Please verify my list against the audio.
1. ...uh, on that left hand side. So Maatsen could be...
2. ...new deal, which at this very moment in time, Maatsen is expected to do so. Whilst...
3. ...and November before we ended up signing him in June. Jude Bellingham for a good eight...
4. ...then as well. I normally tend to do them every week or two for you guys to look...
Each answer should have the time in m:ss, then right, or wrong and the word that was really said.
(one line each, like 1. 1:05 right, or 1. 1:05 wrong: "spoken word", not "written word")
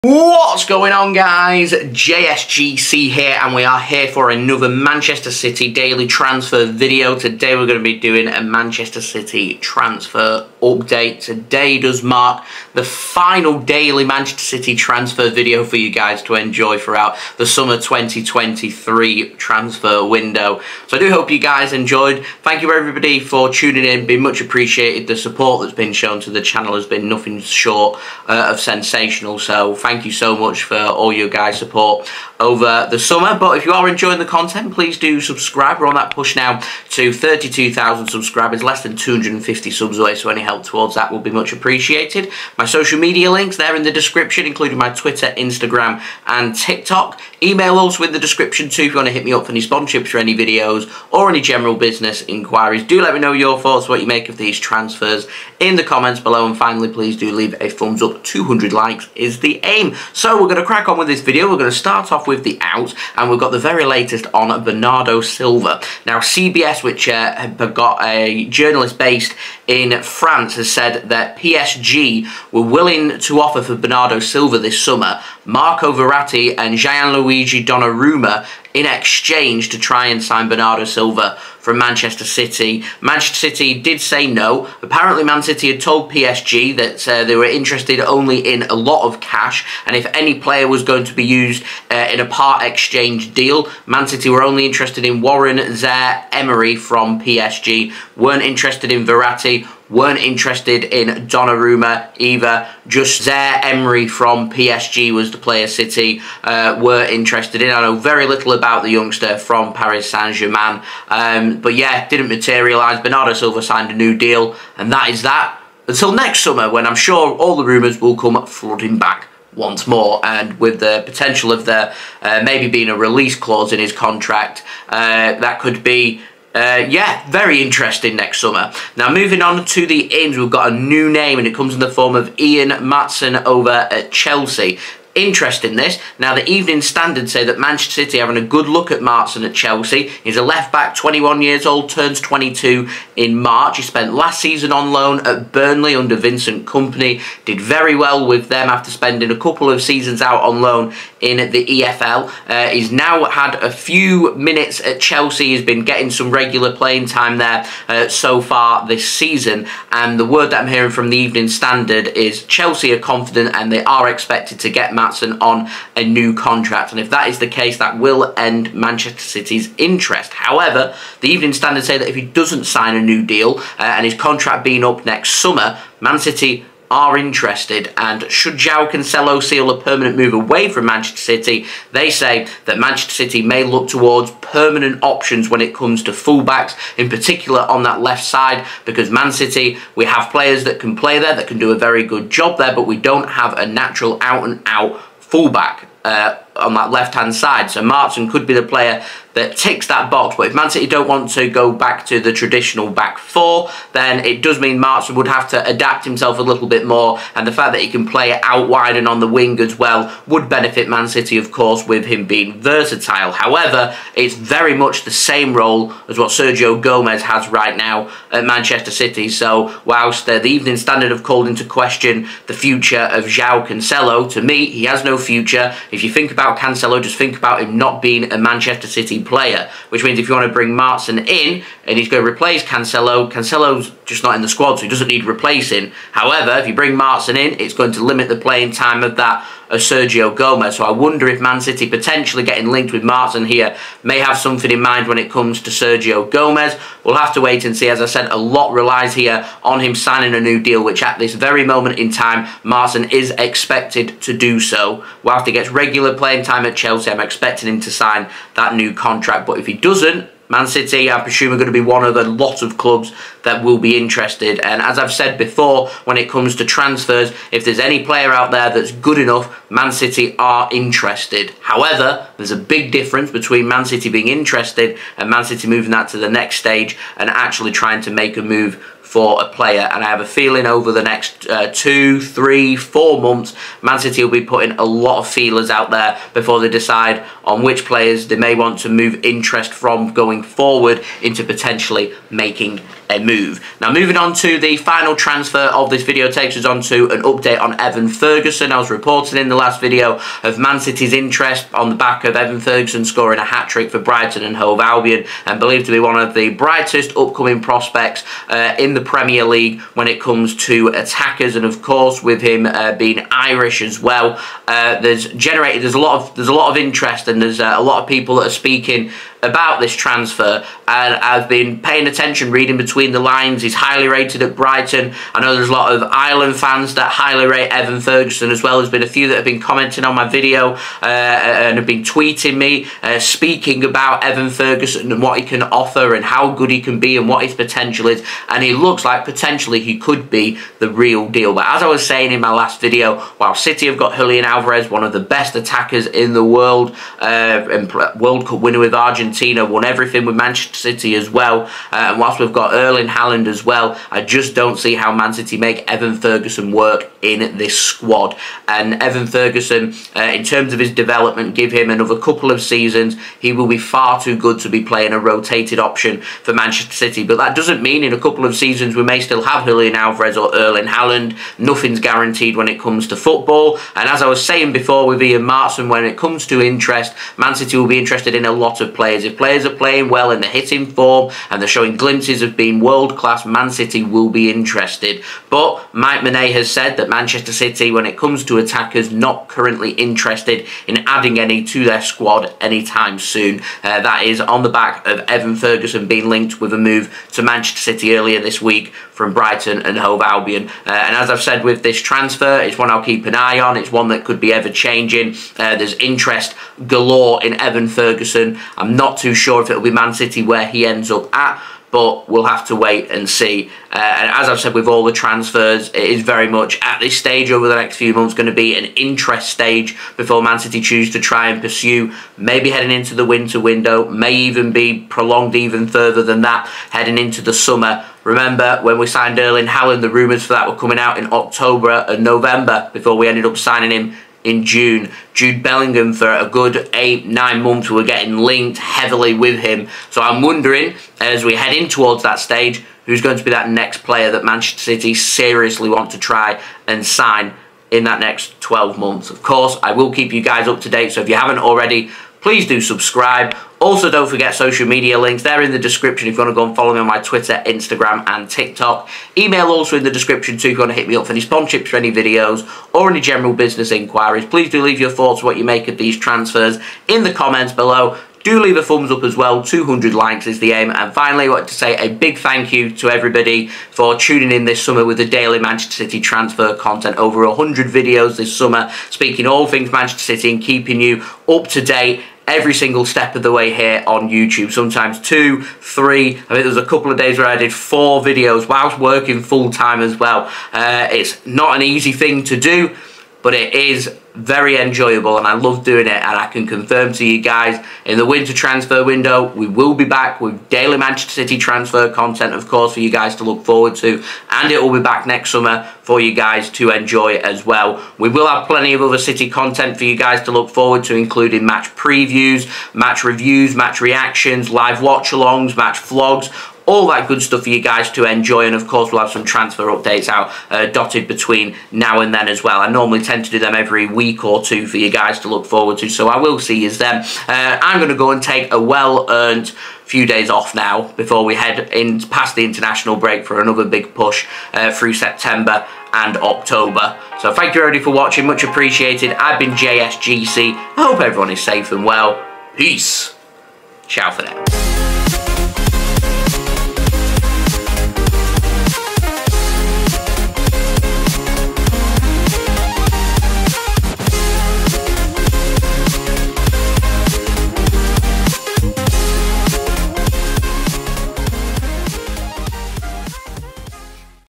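1. 3:16 right
2. 4:10 right
3. 7:12 right
4. 8:42 right.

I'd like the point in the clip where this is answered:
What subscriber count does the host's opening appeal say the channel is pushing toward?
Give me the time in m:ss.
0:37.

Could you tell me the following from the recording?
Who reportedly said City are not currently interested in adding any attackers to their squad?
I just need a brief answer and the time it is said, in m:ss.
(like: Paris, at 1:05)
Mike Minay, at 6:25.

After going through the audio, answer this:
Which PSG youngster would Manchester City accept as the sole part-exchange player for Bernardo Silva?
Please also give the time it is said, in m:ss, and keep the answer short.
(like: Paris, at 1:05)
Warren Zaire Emery, at 1:35.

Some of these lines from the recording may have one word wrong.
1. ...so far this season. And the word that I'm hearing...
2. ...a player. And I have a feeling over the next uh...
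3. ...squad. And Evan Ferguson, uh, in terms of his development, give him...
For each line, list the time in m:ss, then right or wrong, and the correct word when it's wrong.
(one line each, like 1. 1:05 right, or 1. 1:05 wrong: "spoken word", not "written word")
1. 2:38 right
2. 4:39 right
3. 5:57 right.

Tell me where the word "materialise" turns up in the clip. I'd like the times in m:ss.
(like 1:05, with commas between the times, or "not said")
1:52.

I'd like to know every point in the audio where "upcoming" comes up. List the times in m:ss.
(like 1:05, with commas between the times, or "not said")
5:07.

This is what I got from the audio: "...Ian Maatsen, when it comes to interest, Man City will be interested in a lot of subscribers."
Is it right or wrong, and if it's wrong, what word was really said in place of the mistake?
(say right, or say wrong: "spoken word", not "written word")
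wrong: "players", not "subscribers".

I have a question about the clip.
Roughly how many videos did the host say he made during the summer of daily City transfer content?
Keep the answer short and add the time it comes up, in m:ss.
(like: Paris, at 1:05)
Over 100, at 7:57.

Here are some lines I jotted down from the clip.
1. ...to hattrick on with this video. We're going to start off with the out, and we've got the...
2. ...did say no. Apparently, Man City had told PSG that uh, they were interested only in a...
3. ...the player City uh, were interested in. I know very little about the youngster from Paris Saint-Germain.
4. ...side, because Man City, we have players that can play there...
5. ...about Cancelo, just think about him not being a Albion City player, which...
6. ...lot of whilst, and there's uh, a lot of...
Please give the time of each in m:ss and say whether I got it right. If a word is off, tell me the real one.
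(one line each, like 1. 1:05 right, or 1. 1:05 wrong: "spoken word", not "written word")
1. 1:00 wrong: "crack", not "hattrick"
2. 1:23 right
3. 1:45 right
4. 3:08 right
5. 3:46 wrong: "Manchester", not "Albion"
6. 5:16 wrong: "interest", not "whilst".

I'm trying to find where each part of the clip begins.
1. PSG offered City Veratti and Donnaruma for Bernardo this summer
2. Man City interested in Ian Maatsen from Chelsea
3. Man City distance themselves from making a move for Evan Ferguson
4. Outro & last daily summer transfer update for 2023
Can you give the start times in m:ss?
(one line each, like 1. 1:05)
1. 1:00
2. 2:10
3. 4:54
4. 7:30.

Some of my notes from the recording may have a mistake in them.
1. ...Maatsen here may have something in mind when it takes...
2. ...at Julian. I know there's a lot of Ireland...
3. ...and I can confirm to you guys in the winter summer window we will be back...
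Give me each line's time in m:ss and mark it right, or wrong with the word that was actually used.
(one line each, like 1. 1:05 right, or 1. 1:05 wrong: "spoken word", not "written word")
1. 4:03 wrong: "comes", not "takes"
2. 5:24 wrong: "Brighton", not "Julian"
3. 8:16 wrong: "transfer", not "summer".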